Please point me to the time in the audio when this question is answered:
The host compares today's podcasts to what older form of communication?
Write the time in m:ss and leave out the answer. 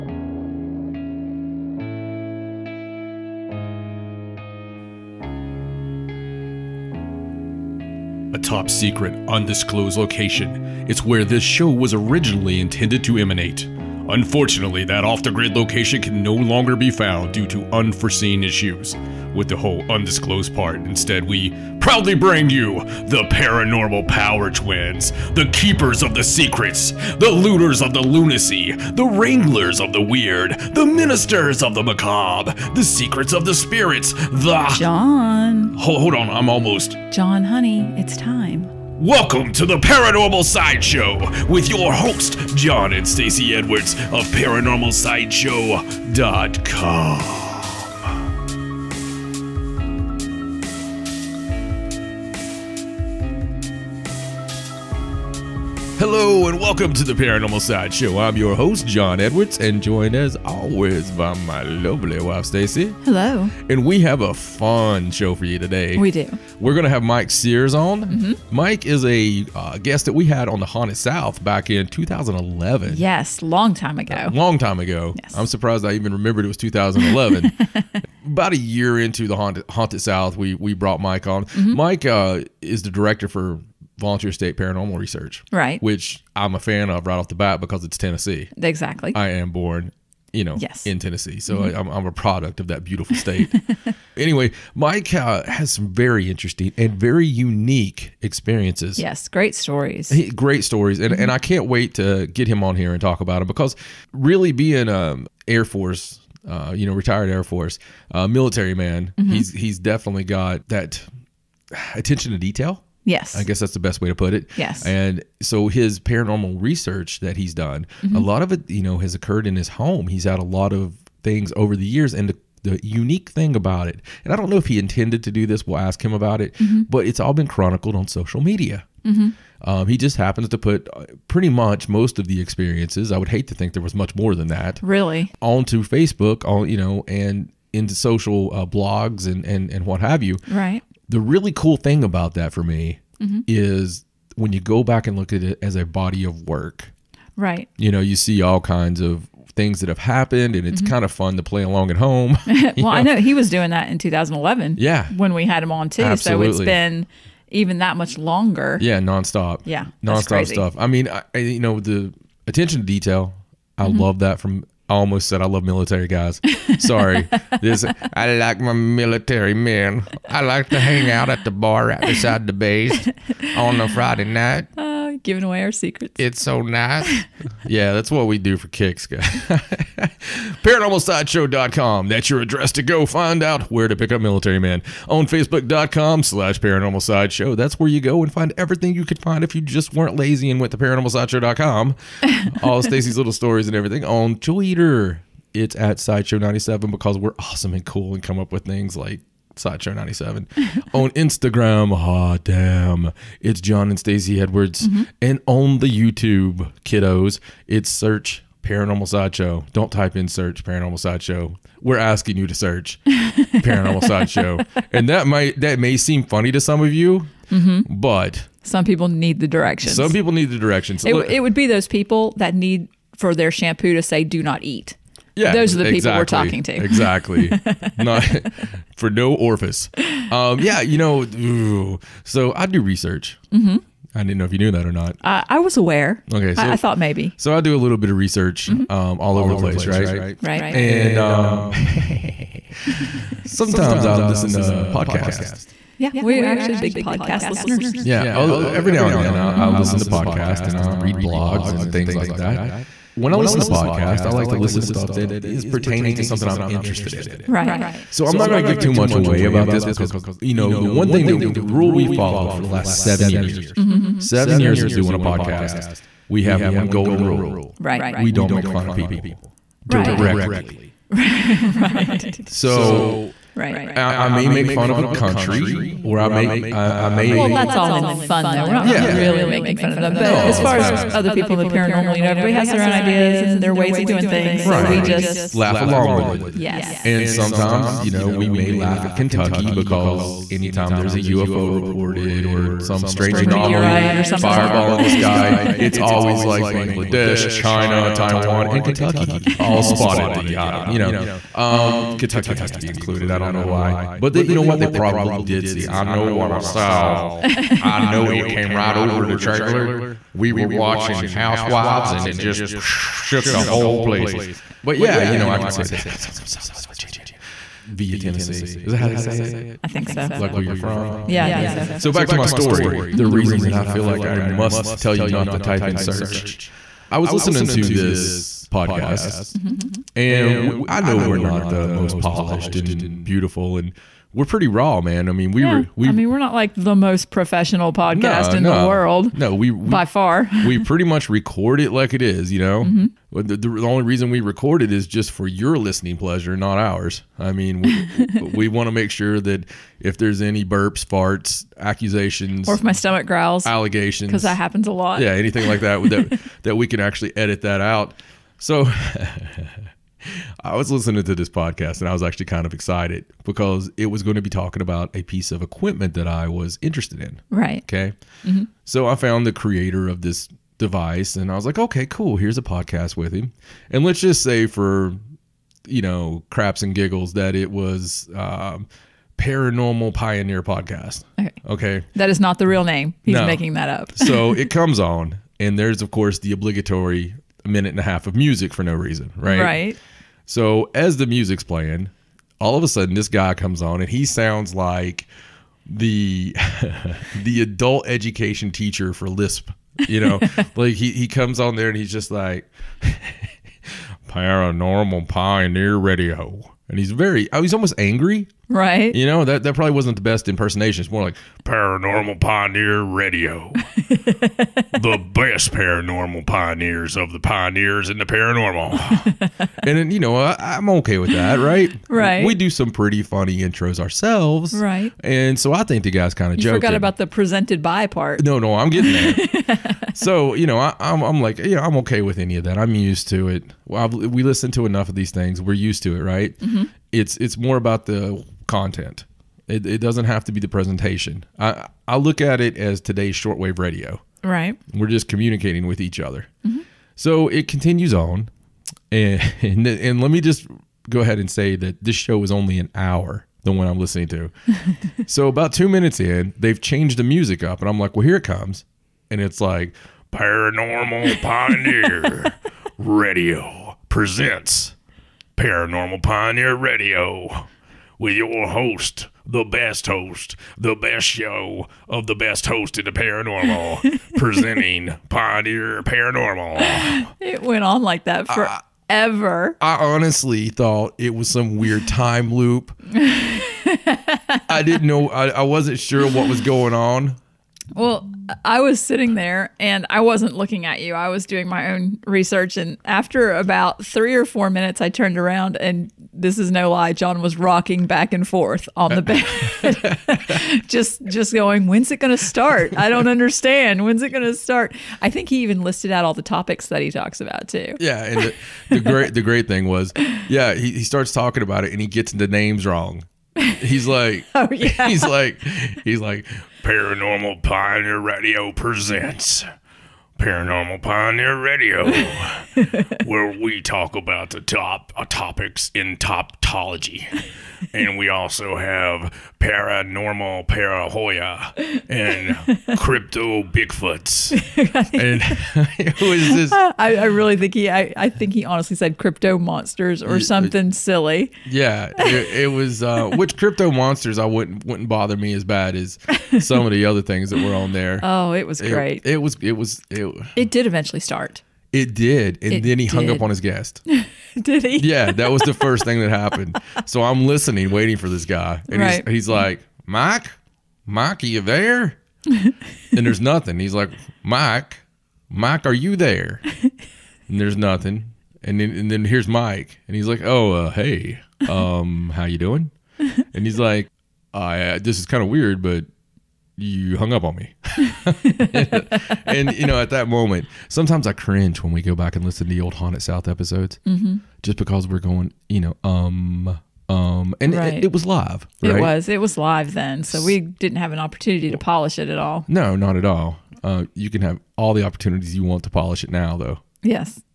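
7:23.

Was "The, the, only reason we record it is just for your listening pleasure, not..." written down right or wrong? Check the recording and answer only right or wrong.
right.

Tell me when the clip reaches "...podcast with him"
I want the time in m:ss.
6:12.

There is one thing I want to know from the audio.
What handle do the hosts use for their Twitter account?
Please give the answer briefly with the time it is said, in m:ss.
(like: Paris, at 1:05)
Sideshow97, at 3:15.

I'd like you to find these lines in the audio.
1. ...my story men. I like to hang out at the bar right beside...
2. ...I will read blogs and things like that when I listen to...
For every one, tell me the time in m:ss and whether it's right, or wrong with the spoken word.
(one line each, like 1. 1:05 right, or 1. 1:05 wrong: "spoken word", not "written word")
1. 2:48 wrong: "military", not "story"
2. 4:10 right.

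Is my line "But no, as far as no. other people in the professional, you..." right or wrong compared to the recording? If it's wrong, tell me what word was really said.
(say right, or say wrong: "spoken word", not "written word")
wrong: "paranormal", not "professional".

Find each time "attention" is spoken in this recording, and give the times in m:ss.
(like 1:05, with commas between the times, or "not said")
1:51, 2:42.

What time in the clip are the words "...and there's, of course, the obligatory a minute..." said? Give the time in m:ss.
6:25.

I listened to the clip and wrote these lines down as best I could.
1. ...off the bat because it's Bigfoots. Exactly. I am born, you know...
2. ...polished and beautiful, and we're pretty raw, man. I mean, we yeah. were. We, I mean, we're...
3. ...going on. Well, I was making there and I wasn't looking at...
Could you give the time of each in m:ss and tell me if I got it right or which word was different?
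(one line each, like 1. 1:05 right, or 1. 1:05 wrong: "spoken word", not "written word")
1. 1:27 wrong: "Tennessee", not "Bigfoots"
2. 5:32 right
3. 8:06 wrong: "sitting", not "making".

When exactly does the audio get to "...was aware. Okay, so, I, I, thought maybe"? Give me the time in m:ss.
3:55.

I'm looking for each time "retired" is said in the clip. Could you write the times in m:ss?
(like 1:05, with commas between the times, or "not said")
1:46.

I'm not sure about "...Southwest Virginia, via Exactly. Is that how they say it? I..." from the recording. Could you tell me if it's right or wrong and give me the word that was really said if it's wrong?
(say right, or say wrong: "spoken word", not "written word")
wrong: "Tennessee", not "Exactly".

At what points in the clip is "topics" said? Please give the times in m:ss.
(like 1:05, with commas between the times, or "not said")
8:26, 8:45.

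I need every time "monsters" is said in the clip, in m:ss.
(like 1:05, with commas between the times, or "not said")
8:59, 9:03.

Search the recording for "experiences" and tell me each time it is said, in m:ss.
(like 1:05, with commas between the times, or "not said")
1:38, 2:12.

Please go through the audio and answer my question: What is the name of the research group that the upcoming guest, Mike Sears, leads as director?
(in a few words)
Volunteer State Paranormal Research.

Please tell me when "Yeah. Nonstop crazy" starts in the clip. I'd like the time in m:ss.
2:39.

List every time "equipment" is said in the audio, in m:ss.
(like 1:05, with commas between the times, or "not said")
6:05.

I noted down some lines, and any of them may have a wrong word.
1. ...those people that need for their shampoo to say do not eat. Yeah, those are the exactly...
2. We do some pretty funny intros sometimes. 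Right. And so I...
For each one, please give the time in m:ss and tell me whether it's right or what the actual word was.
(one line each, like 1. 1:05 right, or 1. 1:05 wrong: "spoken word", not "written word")
1. 3:41 right
2. 7:02 wrong: "ourselves", not "sometimes".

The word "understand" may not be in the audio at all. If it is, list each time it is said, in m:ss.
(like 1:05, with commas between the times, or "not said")
8:23.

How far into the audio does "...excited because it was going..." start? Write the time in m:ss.
6:02.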